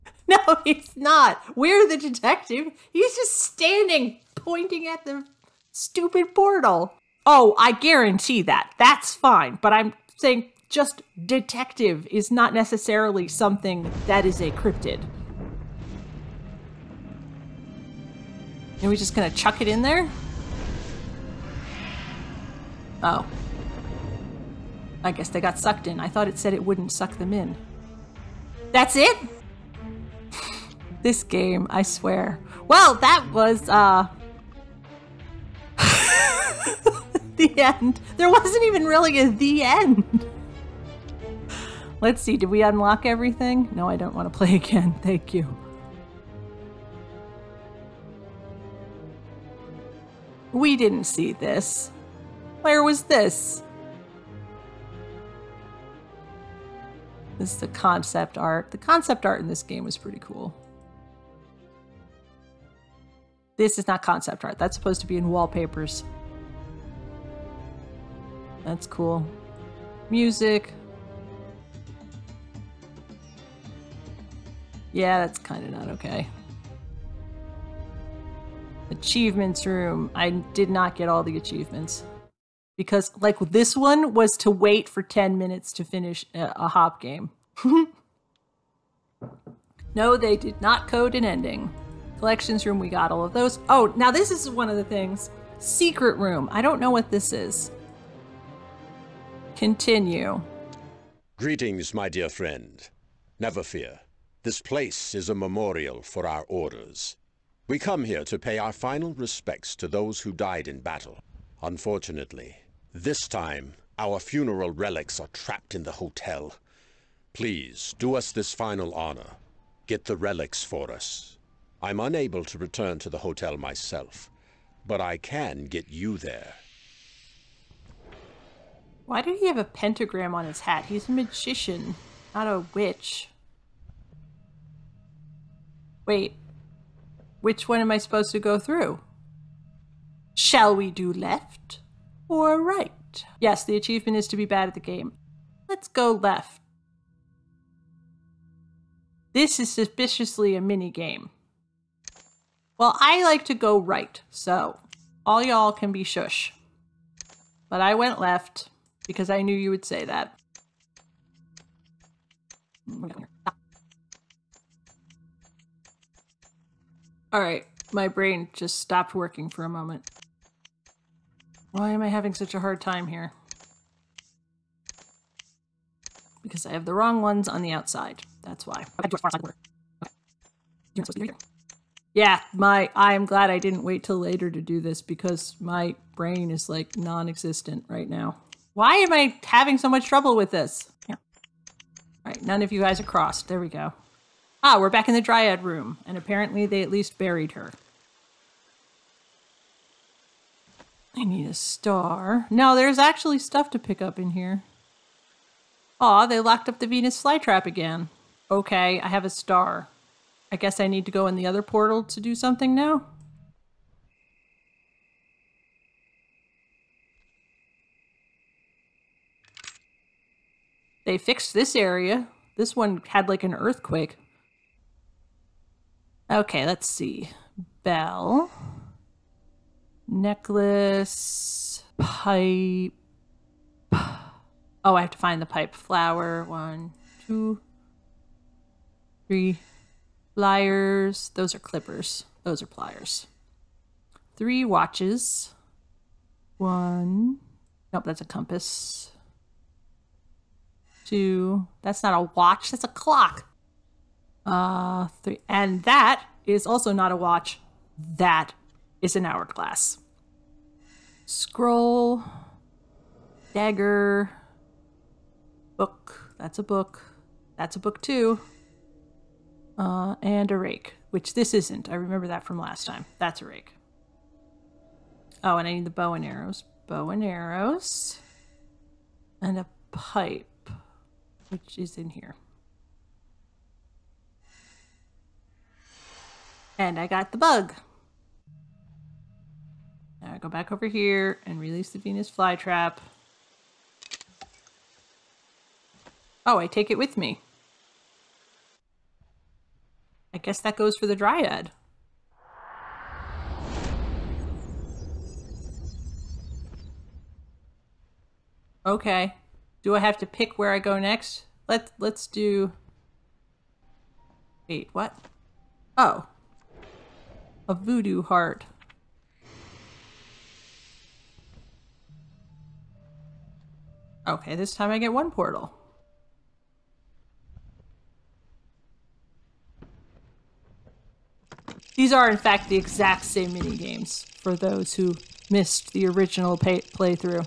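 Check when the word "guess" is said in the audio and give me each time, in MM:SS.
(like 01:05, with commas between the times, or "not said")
00:25, 03:30, 05:00.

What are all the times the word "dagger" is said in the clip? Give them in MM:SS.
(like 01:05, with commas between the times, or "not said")
04:23.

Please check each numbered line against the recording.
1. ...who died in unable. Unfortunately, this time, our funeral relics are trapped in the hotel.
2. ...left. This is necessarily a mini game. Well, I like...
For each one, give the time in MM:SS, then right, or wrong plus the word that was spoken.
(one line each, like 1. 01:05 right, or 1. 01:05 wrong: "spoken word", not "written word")
1. 01:50 wrong: "battle", not "unable"
2. 02:26 wrong: "suspiciously", not "necessarily".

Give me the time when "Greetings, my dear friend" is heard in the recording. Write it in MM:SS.
01:41.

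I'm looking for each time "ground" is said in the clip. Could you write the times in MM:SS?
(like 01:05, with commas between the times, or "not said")
not said.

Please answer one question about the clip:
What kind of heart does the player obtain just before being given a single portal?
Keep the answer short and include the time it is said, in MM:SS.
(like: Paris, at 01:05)
voodoo heart, at 05:17.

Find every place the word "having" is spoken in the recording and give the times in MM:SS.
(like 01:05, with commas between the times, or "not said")
02:52, 03:09.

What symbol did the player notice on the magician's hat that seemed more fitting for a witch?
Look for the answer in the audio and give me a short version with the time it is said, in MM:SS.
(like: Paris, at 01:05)
pentagram, at 02:09.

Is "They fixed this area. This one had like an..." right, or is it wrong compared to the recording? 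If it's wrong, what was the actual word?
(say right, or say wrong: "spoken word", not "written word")
right.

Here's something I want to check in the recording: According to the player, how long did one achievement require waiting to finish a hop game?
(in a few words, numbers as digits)
10 minutes.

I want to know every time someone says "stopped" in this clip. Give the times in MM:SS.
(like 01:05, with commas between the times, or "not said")
02:48.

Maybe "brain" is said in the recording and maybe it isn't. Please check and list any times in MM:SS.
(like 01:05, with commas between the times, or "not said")
02:48, 03:06.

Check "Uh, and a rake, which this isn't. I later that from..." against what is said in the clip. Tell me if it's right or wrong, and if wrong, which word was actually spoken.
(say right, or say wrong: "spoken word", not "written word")
wrong: "remember", not "later".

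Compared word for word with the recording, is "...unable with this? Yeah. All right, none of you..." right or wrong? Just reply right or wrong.
wrong.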